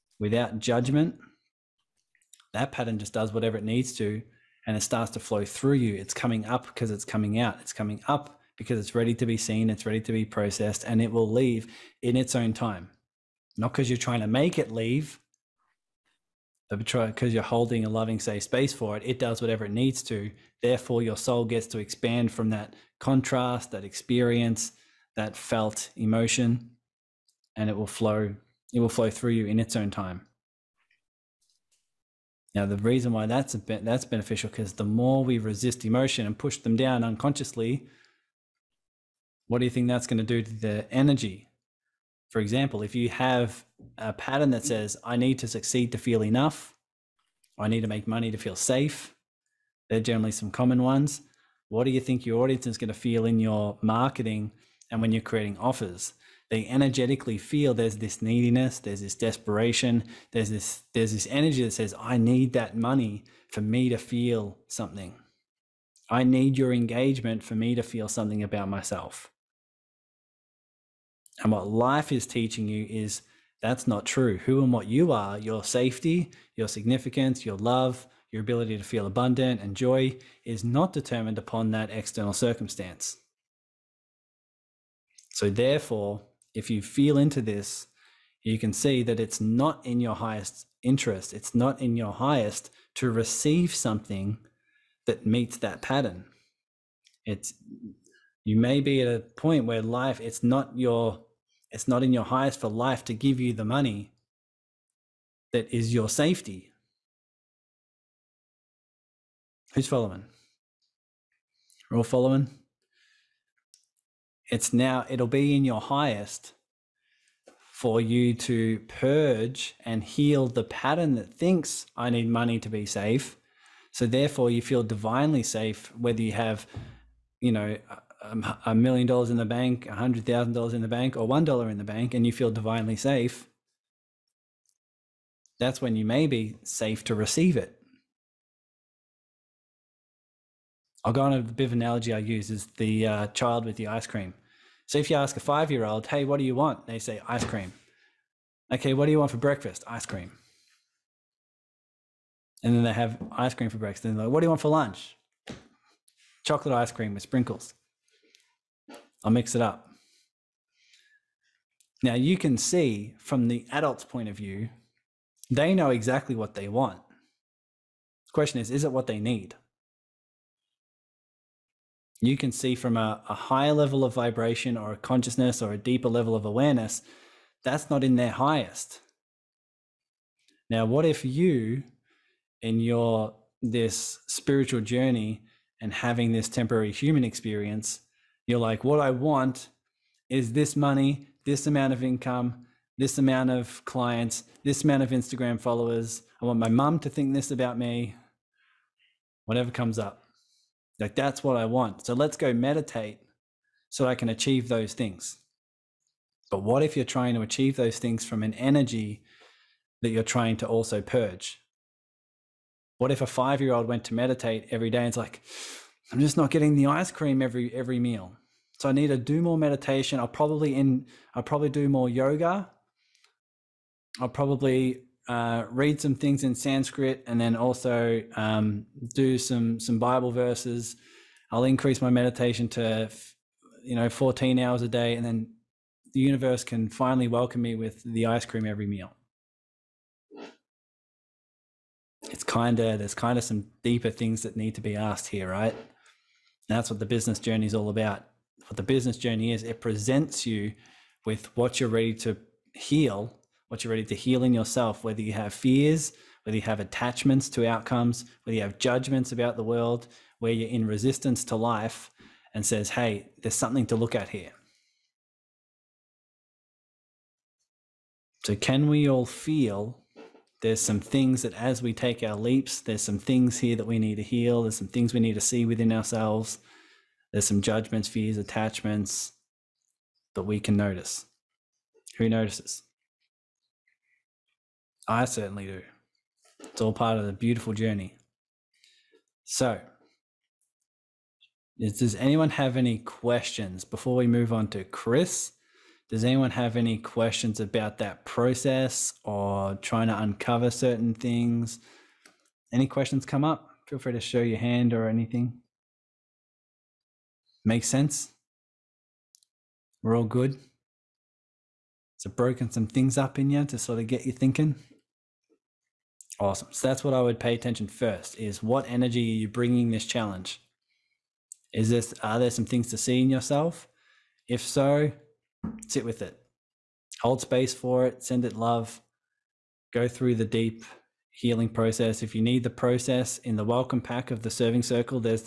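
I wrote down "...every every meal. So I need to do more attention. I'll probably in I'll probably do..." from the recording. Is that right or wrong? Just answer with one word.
wrong.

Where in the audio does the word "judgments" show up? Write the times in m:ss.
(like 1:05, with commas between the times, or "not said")
0:00, 4:18, 4:37.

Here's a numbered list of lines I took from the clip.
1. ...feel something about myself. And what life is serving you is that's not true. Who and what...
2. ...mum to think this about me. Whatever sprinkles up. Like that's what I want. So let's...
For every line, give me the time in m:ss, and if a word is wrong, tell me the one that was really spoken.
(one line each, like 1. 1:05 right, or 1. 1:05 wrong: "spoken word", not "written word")
1. 1:07 wrong: "teaching", not "serving"
2. 3:16 wrong: "comes", not "sprinkles".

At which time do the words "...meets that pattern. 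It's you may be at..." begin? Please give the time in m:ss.
1:35.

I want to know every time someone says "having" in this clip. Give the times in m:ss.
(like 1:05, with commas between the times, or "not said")
3:05.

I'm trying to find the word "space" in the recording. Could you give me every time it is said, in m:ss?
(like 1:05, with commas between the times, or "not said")
0:18, 5:27.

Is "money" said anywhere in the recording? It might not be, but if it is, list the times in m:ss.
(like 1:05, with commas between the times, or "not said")
0:48, 1:02, 1:43, 2:02, 3:10.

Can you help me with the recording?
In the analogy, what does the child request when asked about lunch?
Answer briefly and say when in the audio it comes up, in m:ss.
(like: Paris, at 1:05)
Chocolate ice cream with sprinkles, at 2:36.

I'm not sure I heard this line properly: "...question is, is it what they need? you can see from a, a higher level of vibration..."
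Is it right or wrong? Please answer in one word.
right.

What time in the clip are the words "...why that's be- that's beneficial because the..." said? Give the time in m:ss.
0:33.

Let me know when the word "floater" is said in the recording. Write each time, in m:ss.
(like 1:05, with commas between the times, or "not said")
not said.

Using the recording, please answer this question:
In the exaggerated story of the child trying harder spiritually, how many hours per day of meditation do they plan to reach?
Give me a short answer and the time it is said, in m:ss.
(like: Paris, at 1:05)
14 hours, at 3:54.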